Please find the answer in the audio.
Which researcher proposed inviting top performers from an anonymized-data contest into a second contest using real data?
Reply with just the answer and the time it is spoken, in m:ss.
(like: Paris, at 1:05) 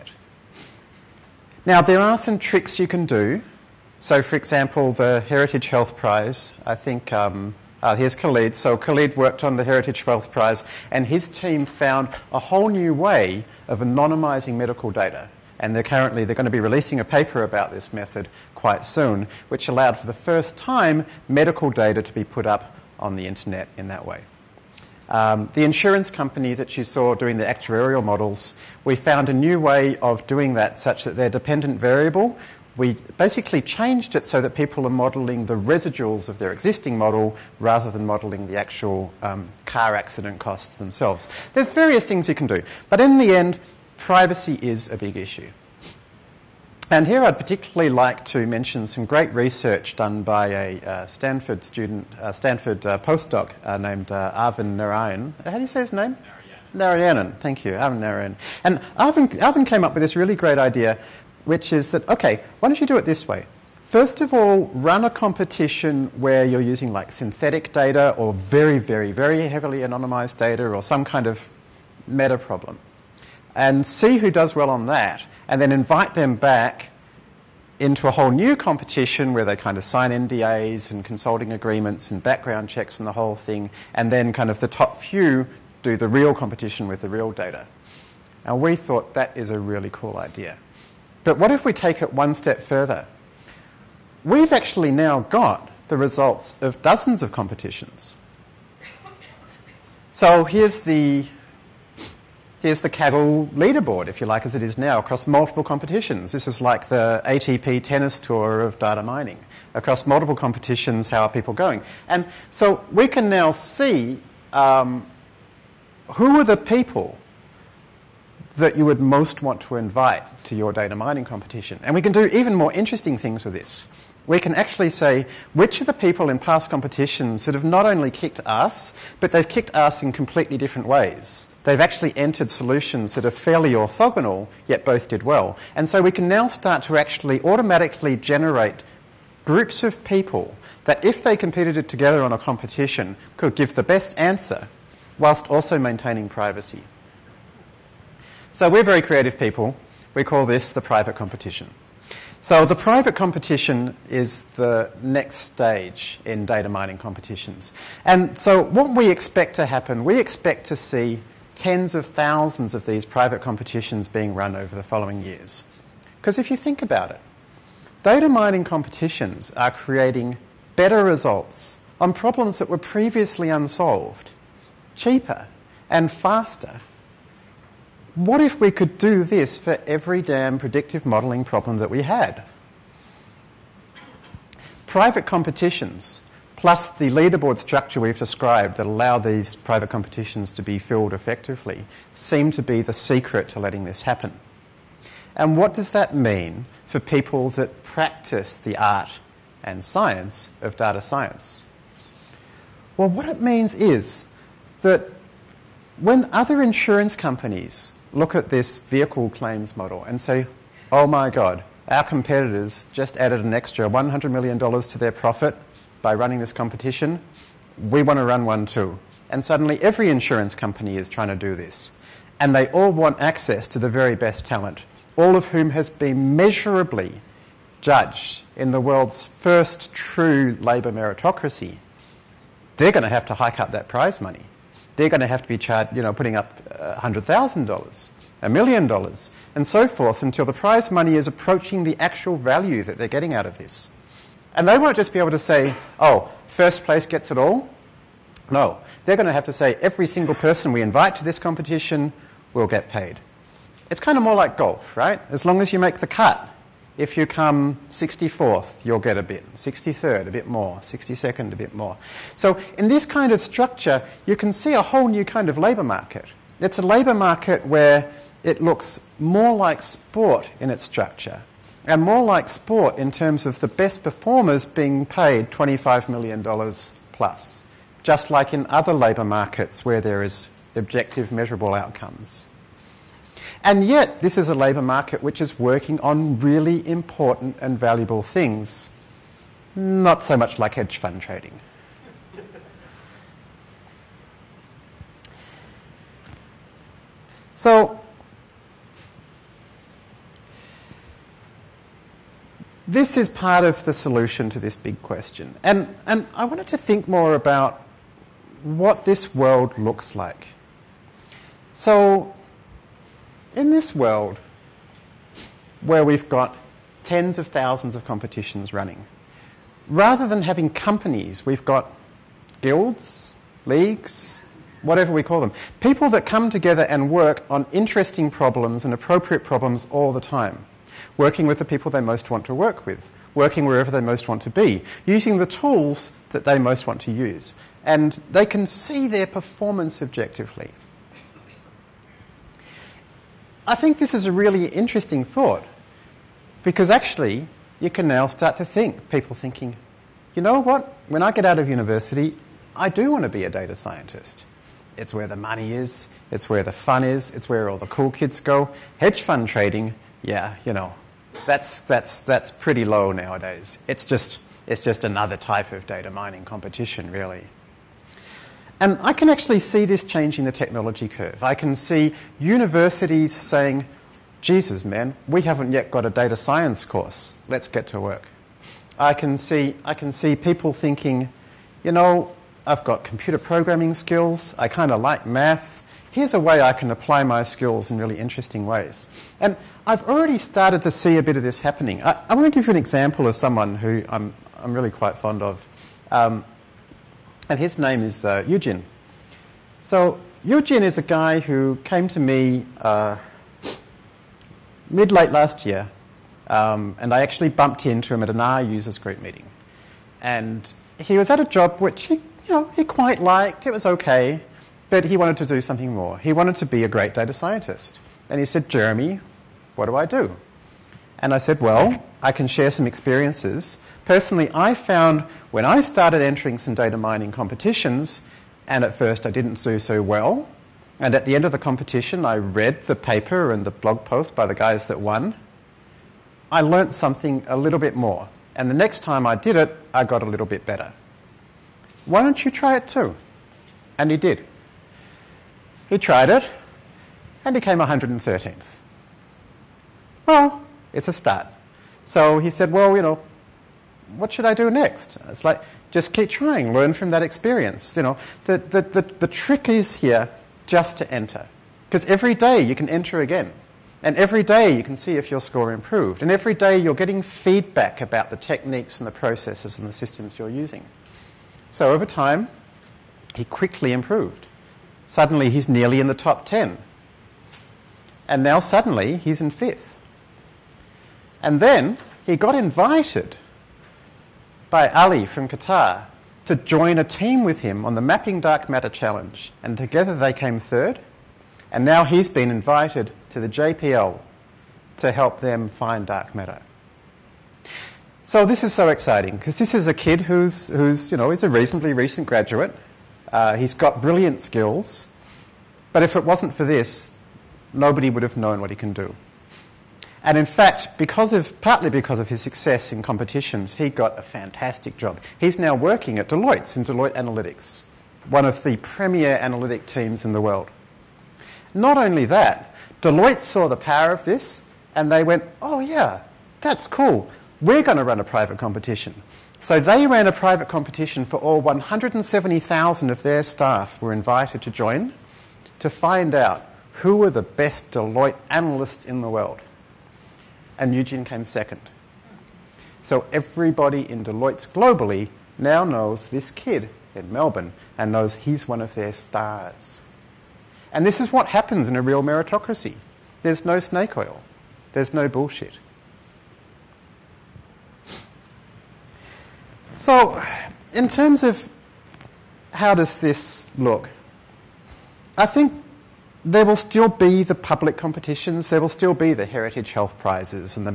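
Arvind Narayanan, at 0:57.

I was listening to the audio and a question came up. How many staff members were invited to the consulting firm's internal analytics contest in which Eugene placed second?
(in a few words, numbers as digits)
170,000.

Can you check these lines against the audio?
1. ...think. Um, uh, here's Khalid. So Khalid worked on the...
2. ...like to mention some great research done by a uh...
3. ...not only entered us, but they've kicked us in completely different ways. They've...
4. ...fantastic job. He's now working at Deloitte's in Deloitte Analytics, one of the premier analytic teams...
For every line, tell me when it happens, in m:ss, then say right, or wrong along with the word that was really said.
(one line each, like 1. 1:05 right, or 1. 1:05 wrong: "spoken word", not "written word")
1. 0:06 right
2. 0:47 right
3. 2:07 wrong: "kicked", not "entered"
4. 8:34 right.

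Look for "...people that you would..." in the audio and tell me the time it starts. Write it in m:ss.
1:56.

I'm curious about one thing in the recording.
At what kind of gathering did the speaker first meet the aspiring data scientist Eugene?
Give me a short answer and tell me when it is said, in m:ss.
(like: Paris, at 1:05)
an R users group meeting, at 6:48.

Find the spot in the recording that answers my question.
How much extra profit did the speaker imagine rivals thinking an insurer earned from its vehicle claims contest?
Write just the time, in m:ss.
3:33.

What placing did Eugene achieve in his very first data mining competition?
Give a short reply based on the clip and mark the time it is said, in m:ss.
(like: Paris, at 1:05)
113th, at 7:27.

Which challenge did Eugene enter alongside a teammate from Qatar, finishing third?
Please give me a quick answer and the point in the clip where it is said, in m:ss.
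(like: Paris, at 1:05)
Mapping Dark Matter Challenge, at 8:07.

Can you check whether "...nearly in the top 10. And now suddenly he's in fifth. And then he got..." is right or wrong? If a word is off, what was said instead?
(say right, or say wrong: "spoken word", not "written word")
right.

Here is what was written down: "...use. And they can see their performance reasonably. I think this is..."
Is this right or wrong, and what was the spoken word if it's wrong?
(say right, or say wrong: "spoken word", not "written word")
wrong: "objectively", not "reasonably".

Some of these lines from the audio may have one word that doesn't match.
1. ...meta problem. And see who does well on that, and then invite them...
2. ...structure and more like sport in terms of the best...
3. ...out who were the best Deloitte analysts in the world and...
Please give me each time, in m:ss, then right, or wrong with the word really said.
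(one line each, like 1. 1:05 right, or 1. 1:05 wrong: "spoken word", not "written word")
1. 1:12 right
2. 4:30 right
3. 8:56 right.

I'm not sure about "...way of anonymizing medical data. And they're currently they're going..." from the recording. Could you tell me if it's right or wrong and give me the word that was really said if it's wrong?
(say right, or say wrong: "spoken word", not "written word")
right.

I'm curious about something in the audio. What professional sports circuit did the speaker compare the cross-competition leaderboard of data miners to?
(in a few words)
ATP tennis tour.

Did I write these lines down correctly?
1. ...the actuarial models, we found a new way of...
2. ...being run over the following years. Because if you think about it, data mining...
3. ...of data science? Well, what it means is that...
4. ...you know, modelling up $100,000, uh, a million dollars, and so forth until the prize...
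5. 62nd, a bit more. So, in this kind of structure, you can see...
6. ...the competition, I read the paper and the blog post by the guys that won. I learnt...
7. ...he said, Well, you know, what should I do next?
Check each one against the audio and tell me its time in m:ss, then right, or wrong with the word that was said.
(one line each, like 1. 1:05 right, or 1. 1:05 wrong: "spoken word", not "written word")
1. 0:27 right
2. 2:44 right
3. 3:20 right
4. 3:55 wrong: "putting", not "modelling"
5. 4:20 right
6. 7:11 right
7. 7:32 right.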